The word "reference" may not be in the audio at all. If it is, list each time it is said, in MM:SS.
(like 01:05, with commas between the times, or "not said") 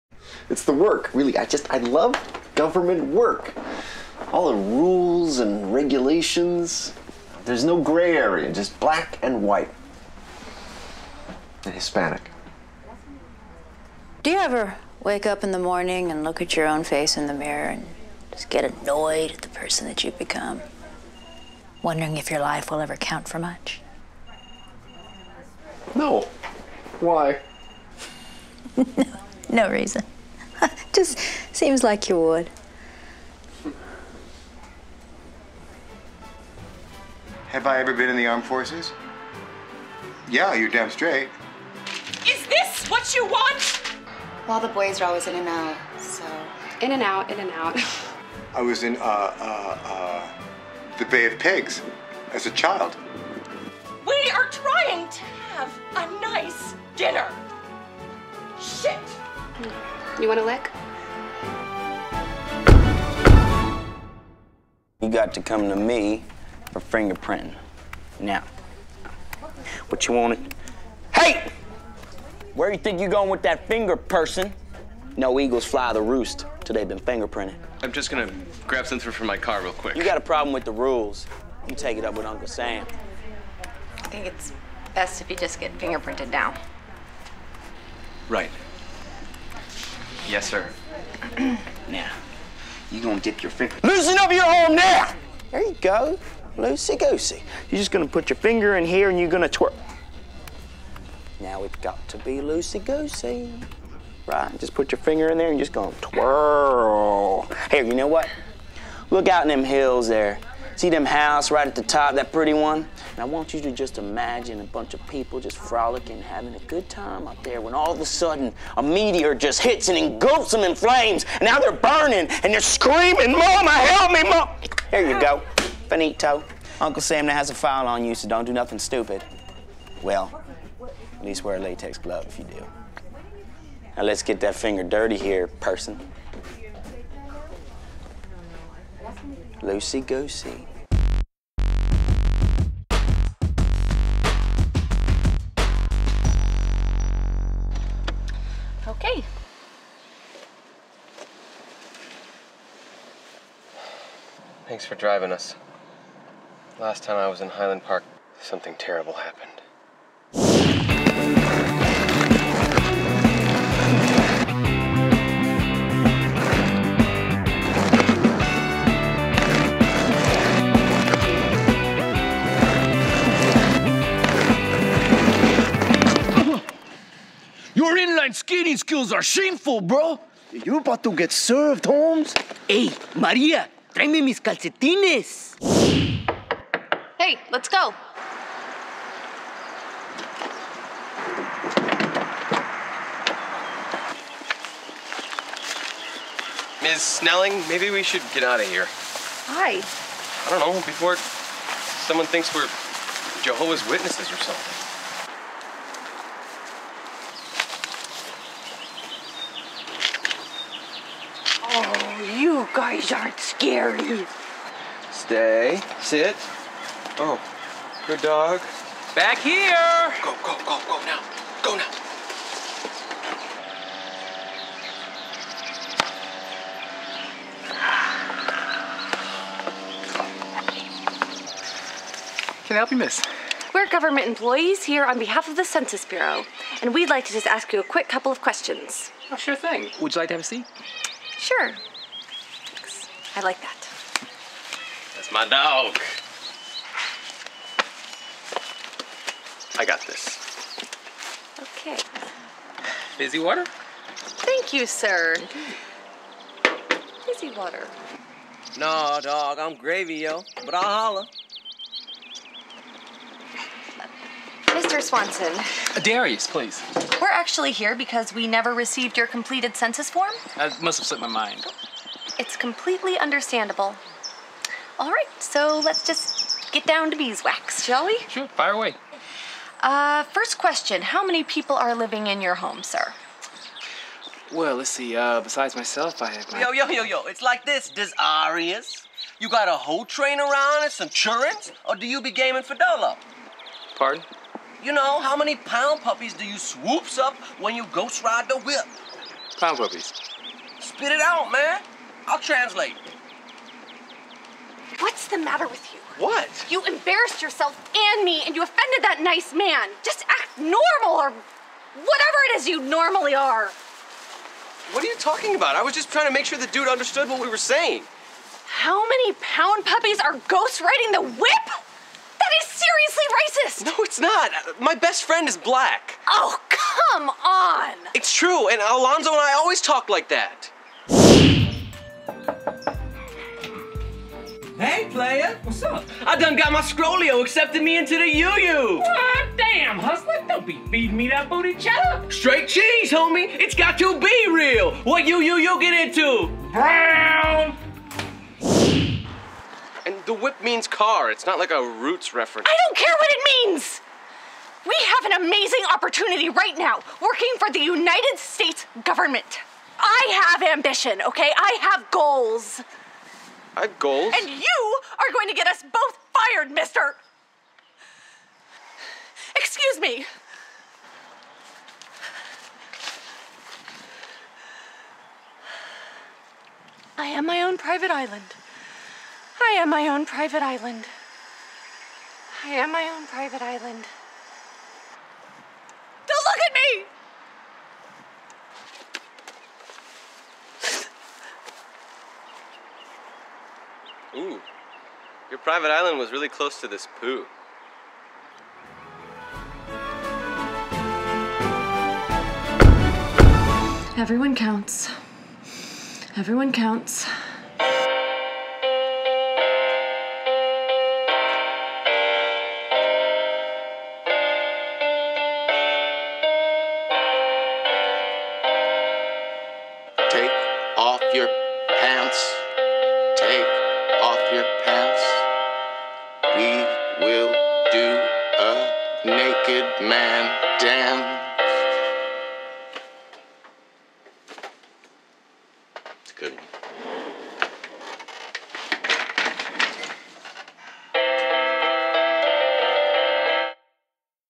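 05:52.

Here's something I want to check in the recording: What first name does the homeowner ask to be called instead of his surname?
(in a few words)
Darius.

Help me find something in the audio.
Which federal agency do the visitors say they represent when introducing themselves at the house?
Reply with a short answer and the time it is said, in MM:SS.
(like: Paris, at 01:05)
Census Bureau, at 03:55.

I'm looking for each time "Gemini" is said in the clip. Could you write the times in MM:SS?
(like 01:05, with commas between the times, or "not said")
not said.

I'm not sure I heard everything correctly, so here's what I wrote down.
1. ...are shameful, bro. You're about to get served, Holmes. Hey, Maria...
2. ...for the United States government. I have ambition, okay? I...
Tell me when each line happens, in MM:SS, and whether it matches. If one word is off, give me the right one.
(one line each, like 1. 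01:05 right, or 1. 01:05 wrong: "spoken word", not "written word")
1. 02:59 right
2. 05:57 right.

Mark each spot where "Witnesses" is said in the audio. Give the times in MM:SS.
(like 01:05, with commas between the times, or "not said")
03:23.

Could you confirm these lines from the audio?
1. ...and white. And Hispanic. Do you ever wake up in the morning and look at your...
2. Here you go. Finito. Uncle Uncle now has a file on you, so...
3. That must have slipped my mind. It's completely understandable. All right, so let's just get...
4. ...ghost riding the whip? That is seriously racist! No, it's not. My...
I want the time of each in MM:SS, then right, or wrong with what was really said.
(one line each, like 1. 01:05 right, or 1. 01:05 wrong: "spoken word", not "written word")
1. 00:09 right
2. 02:04 wrong: "Sam", not "Uncle"
3. 04:30 right
4. 05:20 right.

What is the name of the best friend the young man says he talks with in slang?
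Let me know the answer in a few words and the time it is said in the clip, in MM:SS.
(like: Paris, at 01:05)
Alonzo, at 05:28.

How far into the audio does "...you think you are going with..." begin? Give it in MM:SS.
01:12.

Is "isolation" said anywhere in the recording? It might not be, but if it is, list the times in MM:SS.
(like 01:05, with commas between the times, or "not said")
not said.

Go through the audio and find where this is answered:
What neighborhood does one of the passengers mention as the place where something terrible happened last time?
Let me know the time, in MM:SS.
02:37.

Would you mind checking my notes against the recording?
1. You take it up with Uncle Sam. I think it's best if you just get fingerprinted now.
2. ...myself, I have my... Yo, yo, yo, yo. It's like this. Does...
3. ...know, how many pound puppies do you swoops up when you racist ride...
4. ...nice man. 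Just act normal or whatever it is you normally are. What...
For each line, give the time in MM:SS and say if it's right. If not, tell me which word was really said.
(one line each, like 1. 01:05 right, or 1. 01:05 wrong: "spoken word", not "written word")
1. 01:21 right
2. 04:45 right
3. 04:54 wrong: "ghost", not "racist"
4. 05:09 right.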